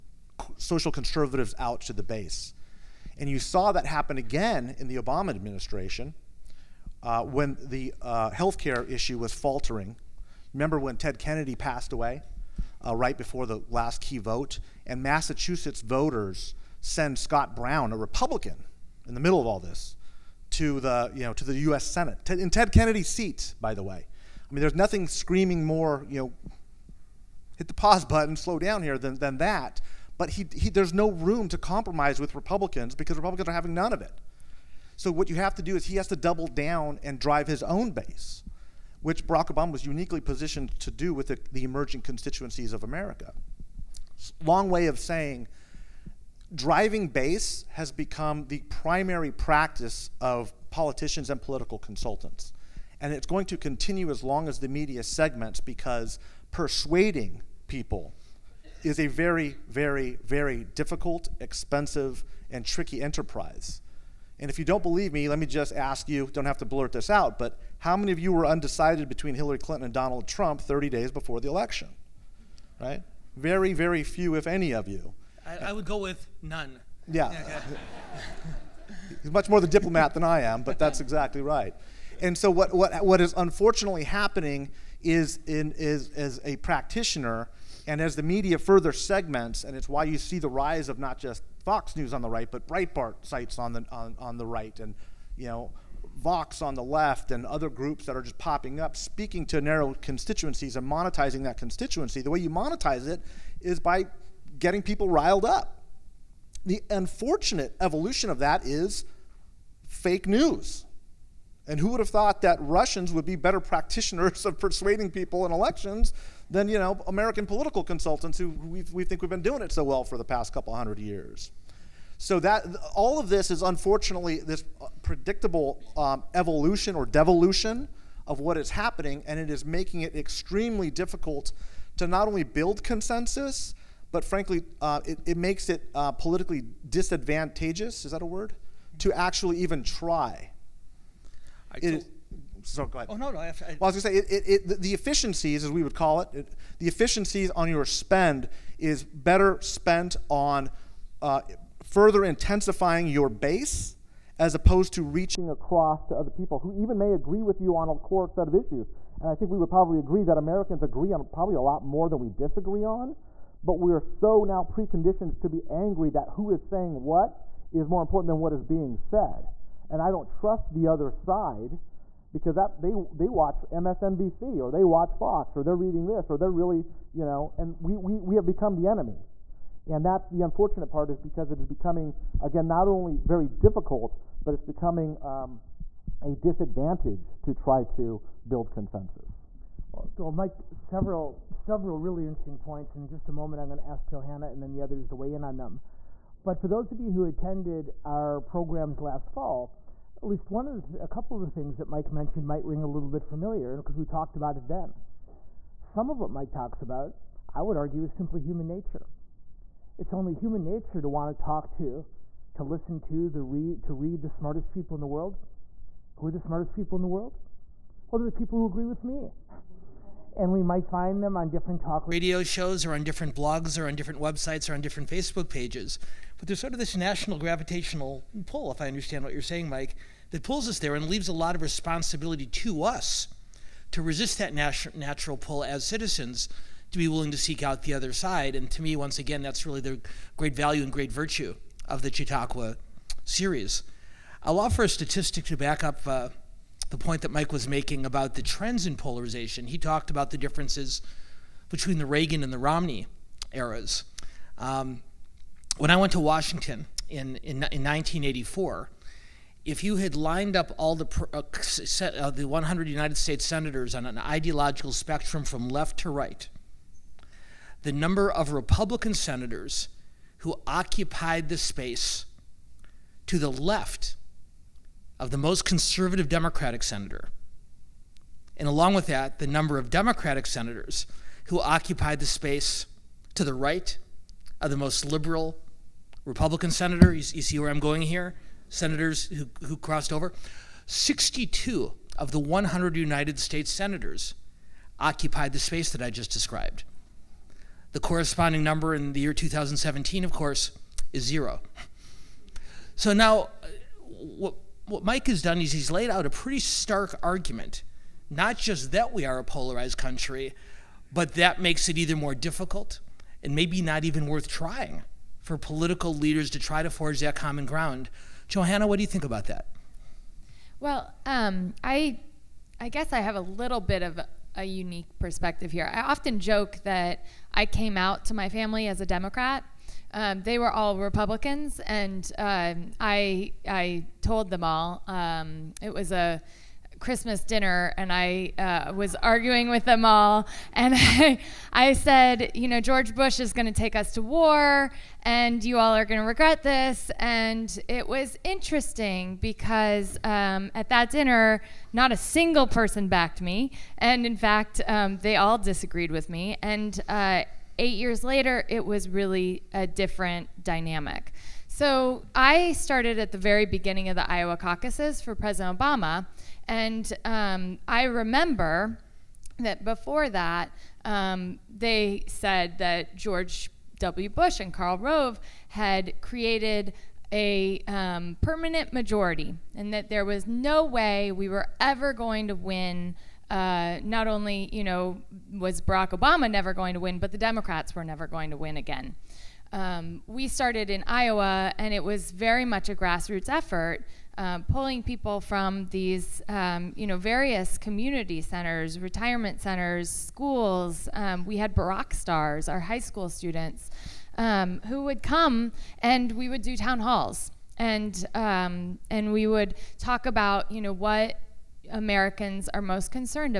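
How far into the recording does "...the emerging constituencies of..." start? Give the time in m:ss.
0:41.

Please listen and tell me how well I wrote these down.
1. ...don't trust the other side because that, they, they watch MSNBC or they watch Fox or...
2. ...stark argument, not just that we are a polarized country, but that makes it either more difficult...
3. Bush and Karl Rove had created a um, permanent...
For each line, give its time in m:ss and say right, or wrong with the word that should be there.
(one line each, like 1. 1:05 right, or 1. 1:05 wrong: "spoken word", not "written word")
1. 2:50 right
2. 5:06 right
3. 6:14 right.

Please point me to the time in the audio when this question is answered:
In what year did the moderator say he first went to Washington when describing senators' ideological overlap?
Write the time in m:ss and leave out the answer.
4:17.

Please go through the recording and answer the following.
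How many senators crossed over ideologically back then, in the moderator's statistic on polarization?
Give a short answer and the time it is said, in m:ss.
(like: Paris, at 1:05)
62, at 4:50.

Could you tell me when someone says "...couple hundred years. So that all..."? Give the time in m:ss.
2:00.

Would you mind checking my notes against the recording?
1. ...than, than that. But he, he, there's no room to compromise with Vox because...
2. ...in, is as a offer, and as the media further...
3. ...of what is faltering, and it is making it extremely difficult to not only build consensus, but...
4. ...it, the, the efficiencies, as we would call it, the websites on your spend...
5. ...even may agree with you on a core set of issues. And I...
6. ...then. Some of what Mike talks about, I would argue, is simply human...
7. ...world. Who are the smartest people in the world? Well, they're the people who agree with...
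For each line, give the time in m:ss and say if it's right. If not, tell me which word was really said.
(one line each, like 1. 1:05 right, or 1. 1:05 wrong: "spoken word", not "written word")
1. 0:28 wrong: "Republicans", not "Vox"
2. 1:25 wrong: "practitioner", not "offer"
3. 2:08 wrong: "happening", not "faltering"
4. 2:24 wrong: "efficiencies", not "websites"
5. 2:36 right
6. 3:24 right
7. 3:35 right.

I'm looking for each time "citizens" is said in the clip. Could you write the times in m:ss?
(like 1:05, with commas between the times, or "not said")
3:55.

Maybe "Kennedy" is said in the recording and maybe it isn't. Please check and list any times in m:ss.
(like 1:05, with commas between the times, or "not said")
0:11, 0:22.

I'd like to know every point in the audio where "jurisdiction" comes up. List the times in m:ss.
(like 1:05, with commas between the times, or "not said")
not said.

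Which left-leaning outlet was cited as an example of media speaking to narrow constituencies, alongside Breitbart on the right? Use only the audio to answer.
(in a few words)
Vox.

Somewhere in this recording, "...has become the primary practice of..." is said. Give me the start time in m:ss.
0:47.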